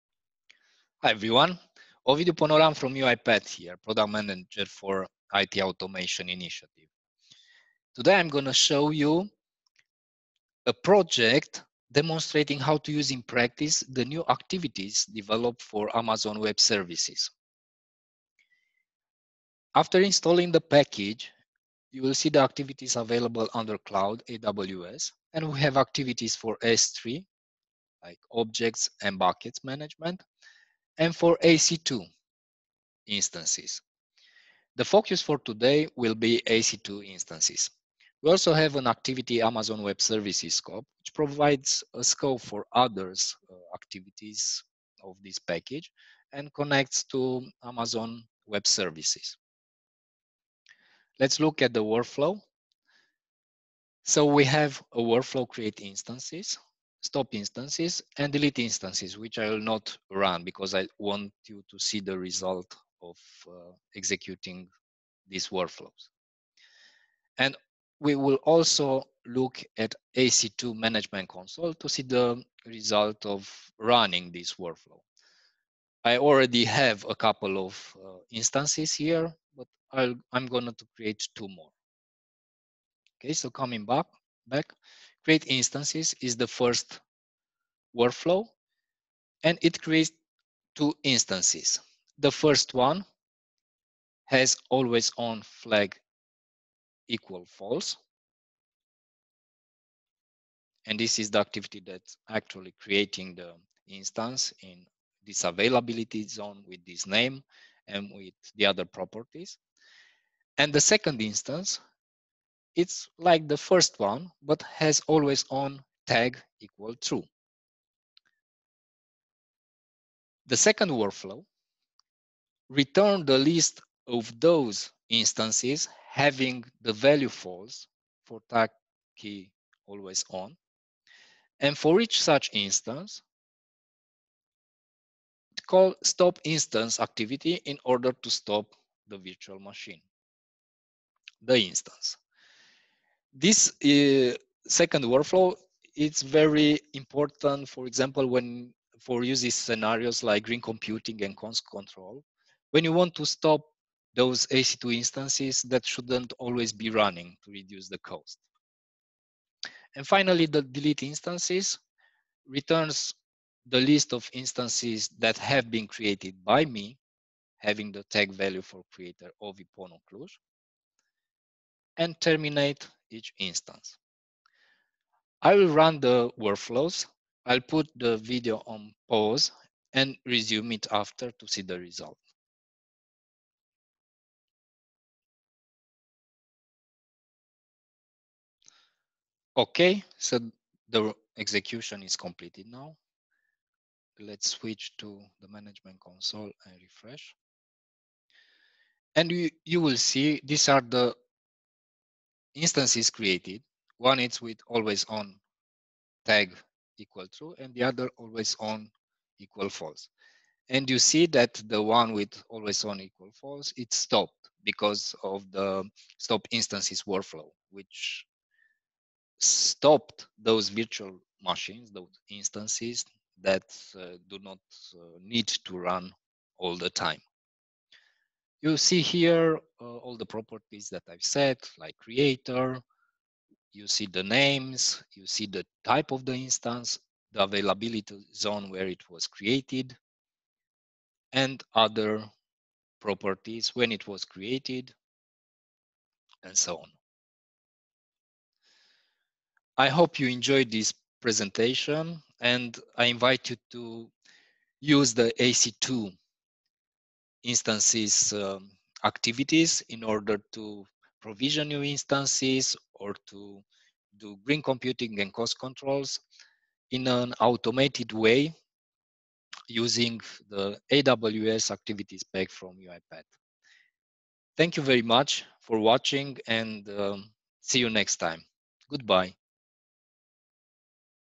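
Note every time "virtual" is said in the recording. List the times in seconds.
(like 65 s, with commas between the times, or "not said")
139 s, 220 s.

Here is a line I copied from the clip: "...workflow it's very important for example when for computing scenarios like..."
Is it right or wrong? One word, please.
wrong.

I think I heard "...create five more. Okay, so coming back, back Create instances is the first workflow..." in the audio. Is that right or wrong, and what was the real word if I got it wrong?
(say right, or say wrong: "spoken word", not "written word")
wrong: "two", not "five".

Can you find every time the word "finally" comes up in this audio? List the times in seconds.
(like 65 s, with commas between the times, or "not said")
160 s.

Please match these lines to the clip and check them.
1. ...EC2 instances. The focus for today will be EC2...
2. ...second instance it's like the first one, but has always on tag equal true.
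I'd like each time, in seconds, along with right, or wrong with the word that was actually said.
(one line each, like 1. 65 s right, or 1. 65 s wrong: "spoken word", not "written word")
1. 31 s right
2. 110 s right.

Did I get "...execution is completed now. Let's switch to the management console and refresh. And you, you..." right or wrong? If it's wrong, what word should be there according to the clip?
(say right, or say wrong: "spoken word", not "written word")
right.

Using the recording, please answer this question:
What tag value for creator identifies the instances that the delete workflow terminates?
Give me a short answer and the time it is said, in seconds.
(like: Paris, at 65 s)
ipono cluj, at 169 s.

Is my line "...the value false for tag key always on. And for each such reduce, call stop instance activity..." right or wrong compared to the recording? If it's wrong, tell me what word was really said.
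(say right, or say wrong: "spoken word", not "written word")
wrong: "instance", not "reduce".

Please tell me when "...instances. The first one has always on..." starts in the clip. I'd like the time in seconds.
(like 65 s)
91 s.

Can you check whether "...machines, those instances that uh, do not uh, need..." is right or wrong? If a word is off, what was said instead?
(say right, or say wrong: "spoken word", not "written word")
right.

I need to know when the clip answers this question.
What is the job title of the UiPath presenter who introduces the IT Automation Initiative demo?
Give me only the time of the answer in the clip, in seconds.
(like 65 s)
3 s.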